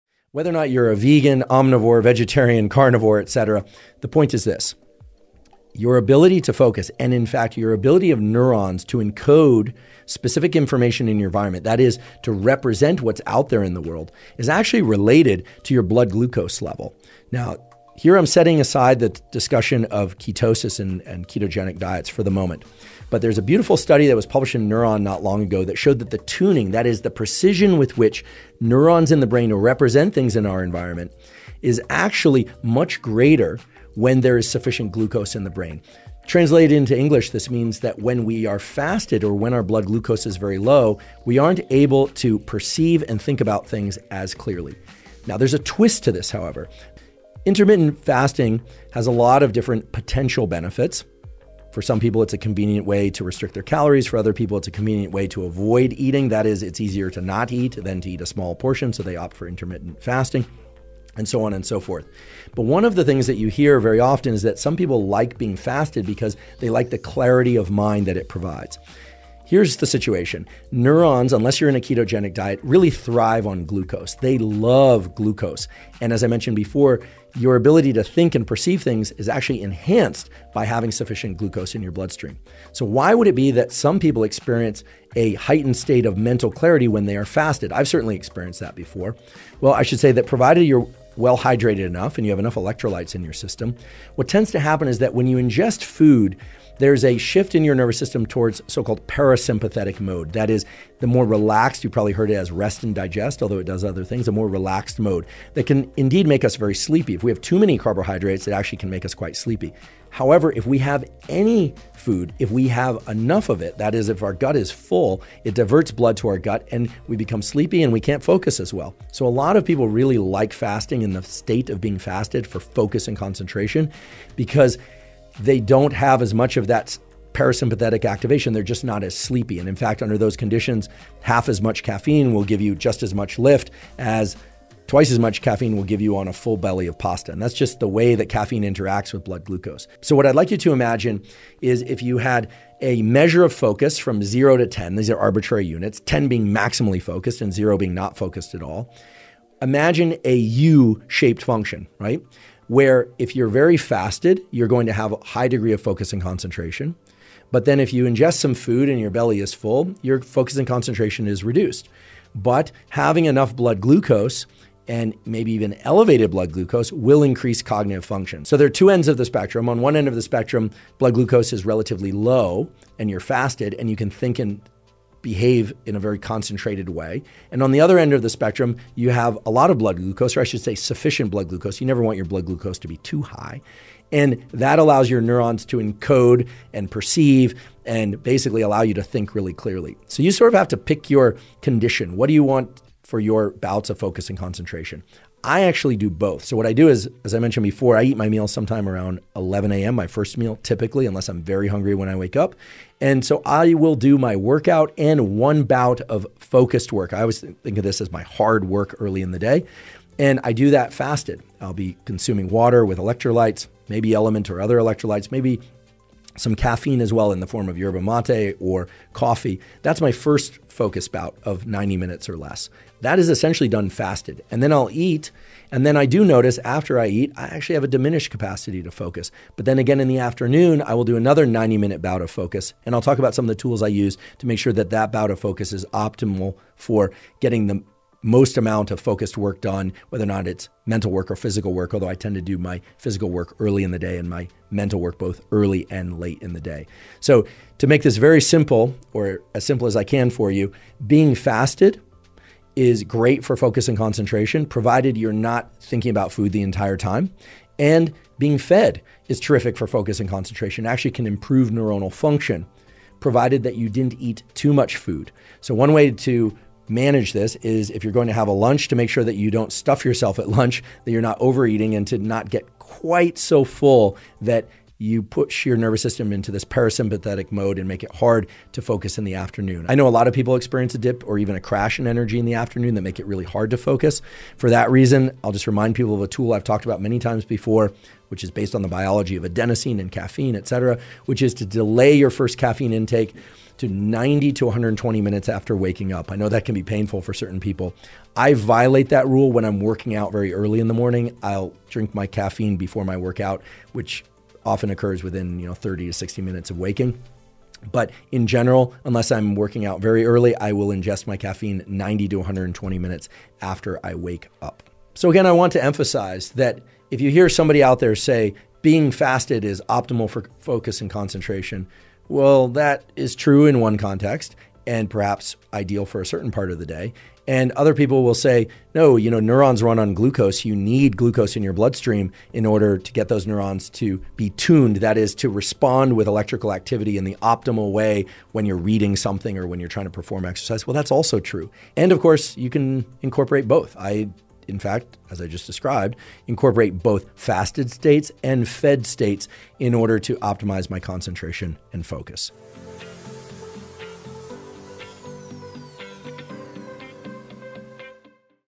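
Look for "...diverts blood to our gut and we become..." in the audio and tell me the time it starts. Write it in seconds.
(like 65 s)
115 s.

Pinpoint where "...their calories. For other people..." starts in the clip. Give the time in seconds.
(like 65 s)
53 s.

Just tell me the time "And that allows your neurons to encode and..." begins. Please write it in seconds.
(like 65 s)
184 s.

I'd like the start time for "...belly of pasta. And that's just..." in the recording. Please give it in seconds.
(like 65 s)
136 s.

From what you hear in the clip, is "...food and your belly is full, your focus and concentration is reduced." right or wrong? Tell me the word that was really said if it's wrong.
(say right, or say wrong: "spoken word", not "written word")
right.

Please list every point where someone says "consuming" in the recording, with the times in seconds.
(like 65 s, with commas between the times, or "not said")
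212 s.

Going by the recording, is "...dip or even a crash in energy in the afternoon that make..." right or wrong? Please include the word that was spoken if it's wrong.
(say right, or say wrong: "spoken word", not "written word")
right.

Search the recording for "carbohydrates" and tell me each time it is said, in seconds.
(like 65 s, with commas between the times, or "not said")
107 s.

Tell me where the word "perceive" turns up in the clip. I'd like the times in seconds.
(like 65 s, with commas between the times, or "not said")
42 s, 78 s, 186 s.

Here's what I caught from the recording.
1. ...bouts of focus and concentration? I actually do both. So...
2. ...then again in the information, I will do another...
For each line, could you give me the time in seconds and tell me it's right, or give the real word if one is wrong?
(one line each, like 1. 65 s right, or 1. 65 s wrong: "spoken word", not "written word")
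1. 193 s right
2. 229 s wrong: "afternoon", not "information".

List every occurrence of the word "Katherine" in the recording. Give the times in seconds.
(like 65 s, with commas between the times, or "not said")
not said.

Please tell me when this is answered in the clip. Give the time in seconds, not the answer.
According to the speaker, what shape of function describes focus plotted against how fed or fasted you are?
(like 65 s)
150 s.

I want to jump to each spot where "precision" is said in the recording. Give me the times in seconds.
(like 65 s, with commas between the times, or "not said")
27 s.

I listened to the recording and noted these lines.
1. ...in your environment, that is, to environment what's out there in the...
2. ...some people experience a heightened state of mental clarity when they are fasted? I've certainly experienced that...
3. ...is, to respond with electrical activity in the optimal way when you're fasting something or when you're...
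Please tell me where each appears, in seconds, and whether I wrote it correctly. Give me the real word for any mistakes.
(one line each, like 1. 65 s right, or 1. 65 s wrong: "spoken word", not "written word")
1. 11 s wrong: "represent", not "environment"
2. 83 s right
3. 335 s wrong: "reading", not "fasting".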